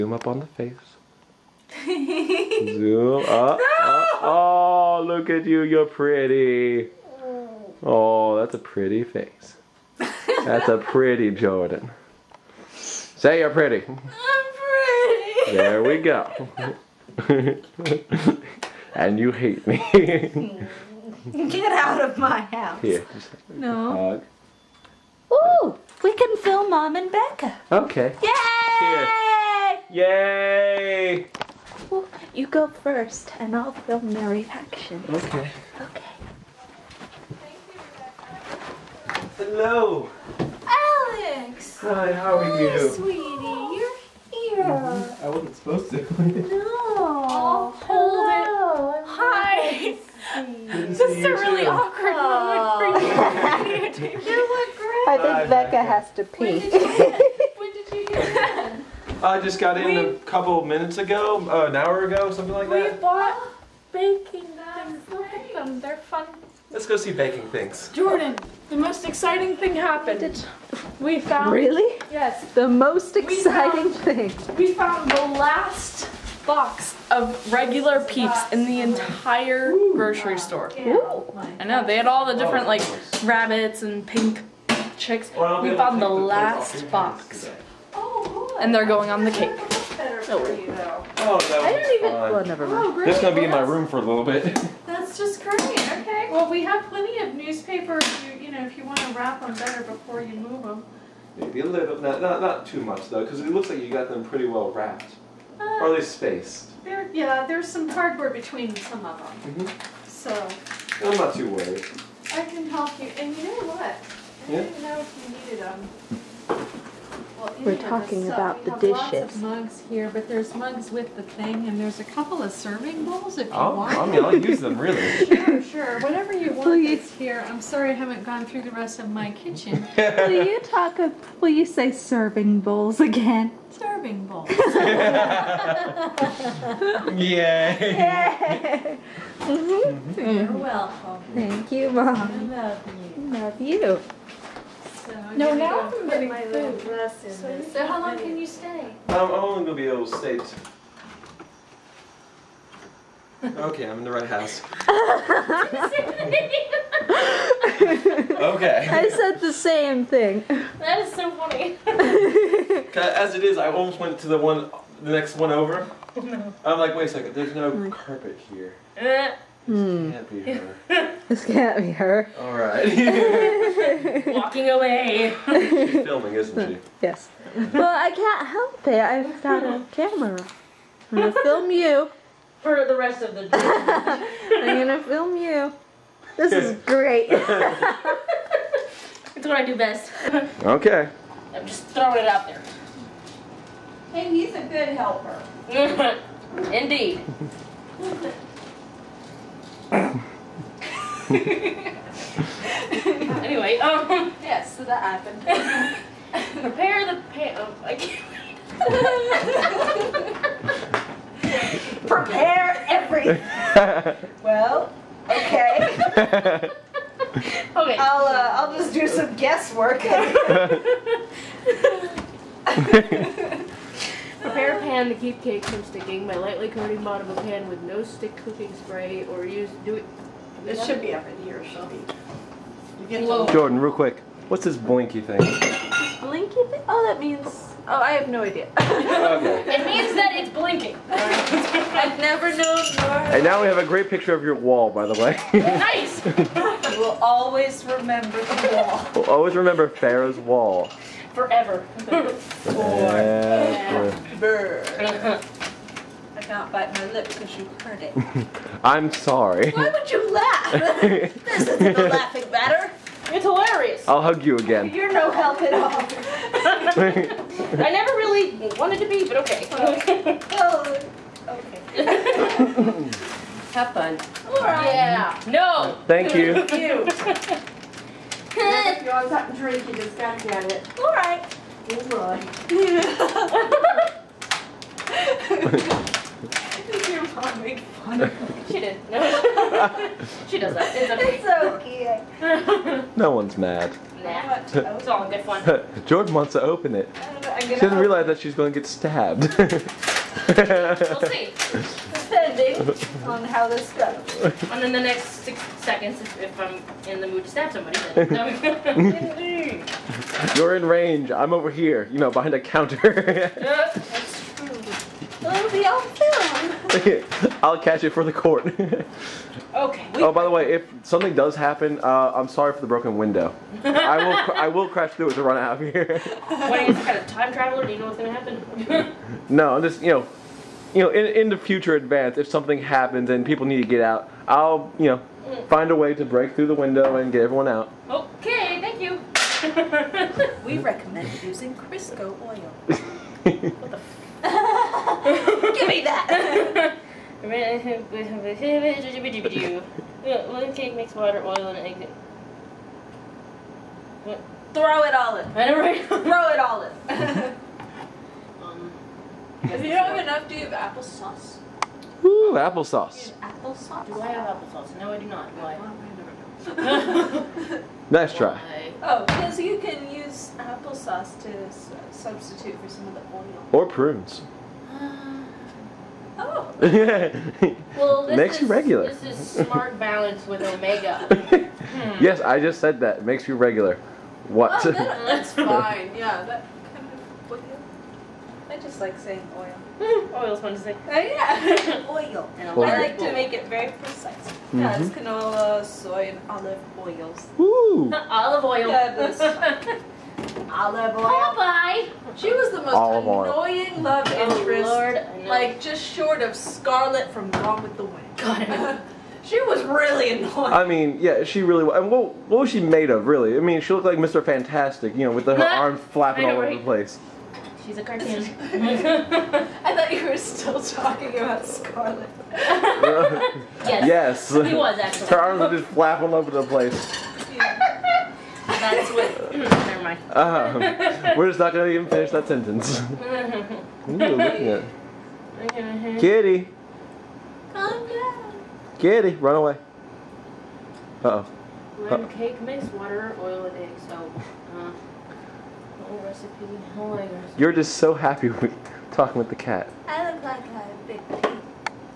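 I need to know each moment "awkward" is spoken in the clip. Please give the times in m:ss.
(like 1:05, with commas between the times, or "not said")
0:51.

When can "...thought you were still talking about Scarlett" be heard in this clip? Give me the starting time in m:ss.
6:59.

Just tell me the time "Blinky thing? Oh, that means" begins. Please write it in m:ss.
3:55.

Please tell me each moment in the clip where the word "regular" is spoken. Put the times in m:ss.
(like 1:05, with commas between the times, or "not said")
1:17, 6:18, 6:23.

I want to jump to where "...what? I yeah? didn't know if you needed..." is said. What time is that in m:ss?
1:53.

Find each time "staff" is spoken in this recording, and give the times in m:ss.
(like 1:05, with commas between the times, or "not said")
not said.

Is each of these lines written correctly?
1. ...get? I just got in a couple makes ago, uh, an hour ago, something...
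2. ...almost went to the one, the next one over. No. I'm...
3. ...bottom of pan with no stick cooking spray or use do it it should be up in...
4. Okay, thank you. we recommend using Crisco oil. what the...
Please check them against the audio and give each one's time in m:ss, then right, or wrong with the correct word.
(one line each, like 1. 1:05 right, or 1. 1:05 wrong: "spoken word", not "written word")
1. 0:58 wrong: "minutes", not "makes"
2. 2:43 right
3. 3:47 right
4. 5:38 right.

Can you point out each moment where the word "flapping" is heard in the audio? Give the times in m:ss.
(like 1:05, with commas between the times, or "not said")
6:56, 7:05.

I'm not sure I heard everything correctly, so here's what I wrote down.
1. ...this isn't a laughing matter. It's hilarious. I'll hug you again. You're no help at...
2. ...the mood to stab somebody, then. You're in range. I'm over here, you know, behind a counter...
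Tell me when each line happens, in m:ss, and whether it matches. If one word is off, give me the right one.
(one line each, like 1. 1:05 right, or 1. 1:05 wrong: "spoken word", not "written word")
1. 4:21 right
2. 5:07 right.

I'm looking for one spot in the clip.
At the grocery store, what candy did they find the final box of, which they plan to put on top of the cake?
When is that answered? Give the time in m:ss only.
1:18.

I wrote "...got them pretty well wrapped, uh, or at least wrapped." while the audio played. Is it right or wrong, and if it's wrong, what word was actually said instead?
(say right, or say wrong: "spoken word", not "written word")
wrong: "spaced", not "wrapped".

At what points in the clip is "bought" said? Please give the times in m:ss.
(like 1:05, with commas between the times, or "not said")
1:02.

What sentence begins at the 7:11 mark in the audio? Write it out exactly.
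we're just not gonna even finish that sentence.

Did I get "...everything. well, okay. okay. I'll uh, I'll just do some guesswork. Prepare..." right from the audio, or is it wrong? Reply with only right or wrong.
right.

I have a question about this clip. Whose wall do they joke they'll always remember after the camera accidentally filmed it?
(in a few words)
Farah's.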